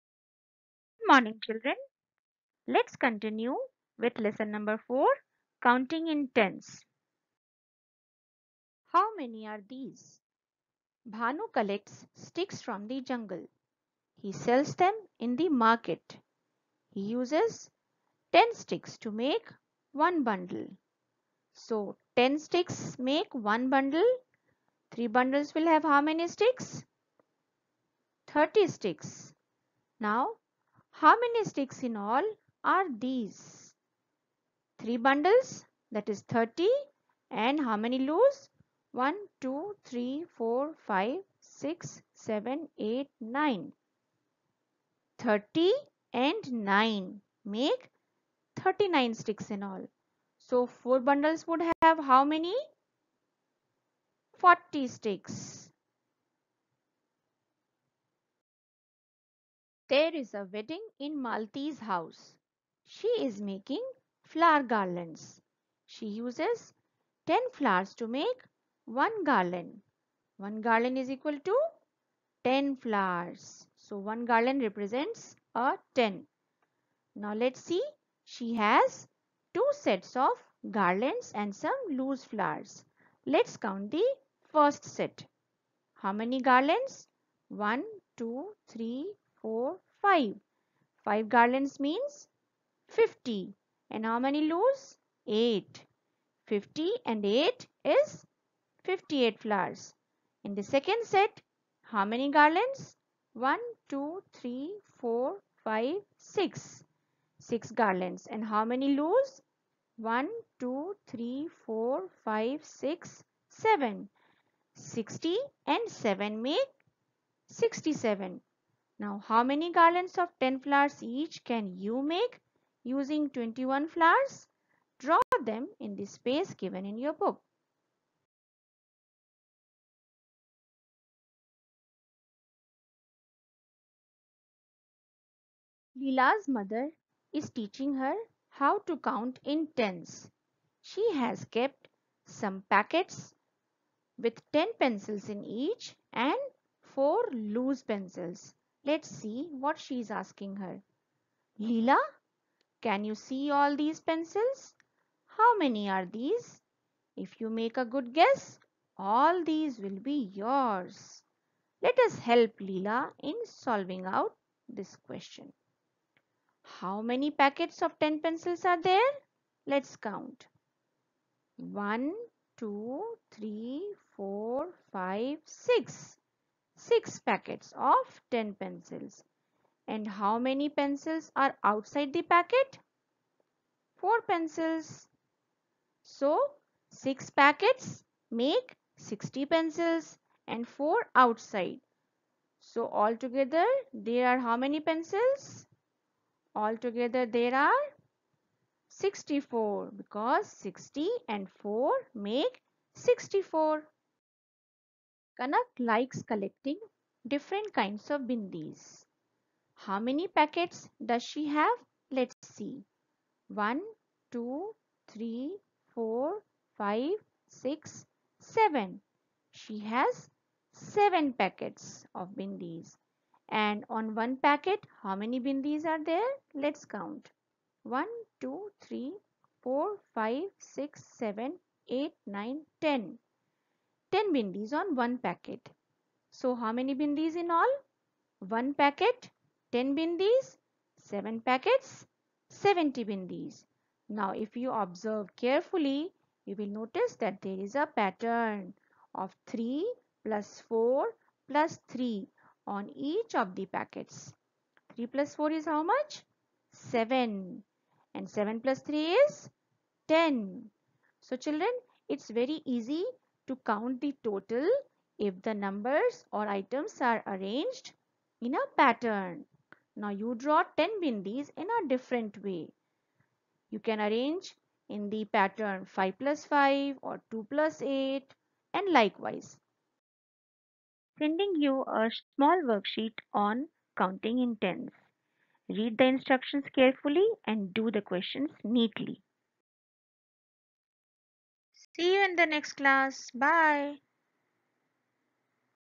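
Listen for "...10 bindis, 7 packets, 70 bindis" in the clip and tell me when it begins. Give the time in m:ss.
3:59.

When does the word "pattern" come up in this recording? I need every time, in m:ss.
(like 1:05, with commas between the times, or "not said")
4:07, 4:28, 4:35.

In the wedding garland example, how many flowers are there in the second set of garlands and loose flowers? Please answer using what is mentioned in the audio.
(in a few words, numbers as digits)
67.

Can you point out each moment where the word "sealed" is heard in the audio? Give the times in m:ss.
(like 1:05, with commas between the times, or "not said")
not said.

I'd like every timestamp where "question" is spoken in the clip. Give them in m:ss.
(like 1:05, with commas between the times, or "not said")
2:44, 4:48.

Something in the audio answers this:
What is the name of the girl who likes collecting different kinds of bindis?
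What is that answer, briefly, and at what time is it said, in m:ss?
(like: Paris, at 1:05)
Kanak, at 3:25.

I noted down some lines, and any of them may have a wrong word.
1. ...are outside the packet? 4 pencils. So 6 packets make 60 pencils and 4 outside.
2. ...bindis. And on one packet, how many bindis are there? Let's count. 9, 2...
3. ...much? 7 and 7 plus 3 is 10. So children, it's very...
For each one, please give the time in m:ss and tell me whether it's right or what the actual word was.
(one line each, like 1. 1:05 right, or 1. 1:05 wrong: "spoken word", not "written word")
1. 3:01 right
2. 3:42 wrong: "1", not "9"
3. 4:15 right.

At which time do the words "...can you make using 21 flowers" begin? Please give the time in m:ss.
2:01.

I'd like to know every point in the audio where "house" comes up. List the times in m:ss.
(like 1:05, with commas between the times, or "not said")
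1:01.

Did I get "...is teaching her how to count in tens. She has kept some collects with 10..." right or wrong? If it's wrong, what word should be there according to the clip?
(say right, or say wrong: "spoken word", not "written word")
wrong: "packets", not "collects".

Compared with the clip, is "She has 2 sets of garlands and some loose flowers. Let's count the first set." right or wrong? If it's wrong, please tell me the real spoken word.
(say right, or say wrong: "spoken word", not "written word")
right.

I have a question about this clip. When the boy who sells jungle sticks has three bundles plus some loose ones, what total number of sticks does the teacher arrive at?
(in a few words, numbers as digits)
39.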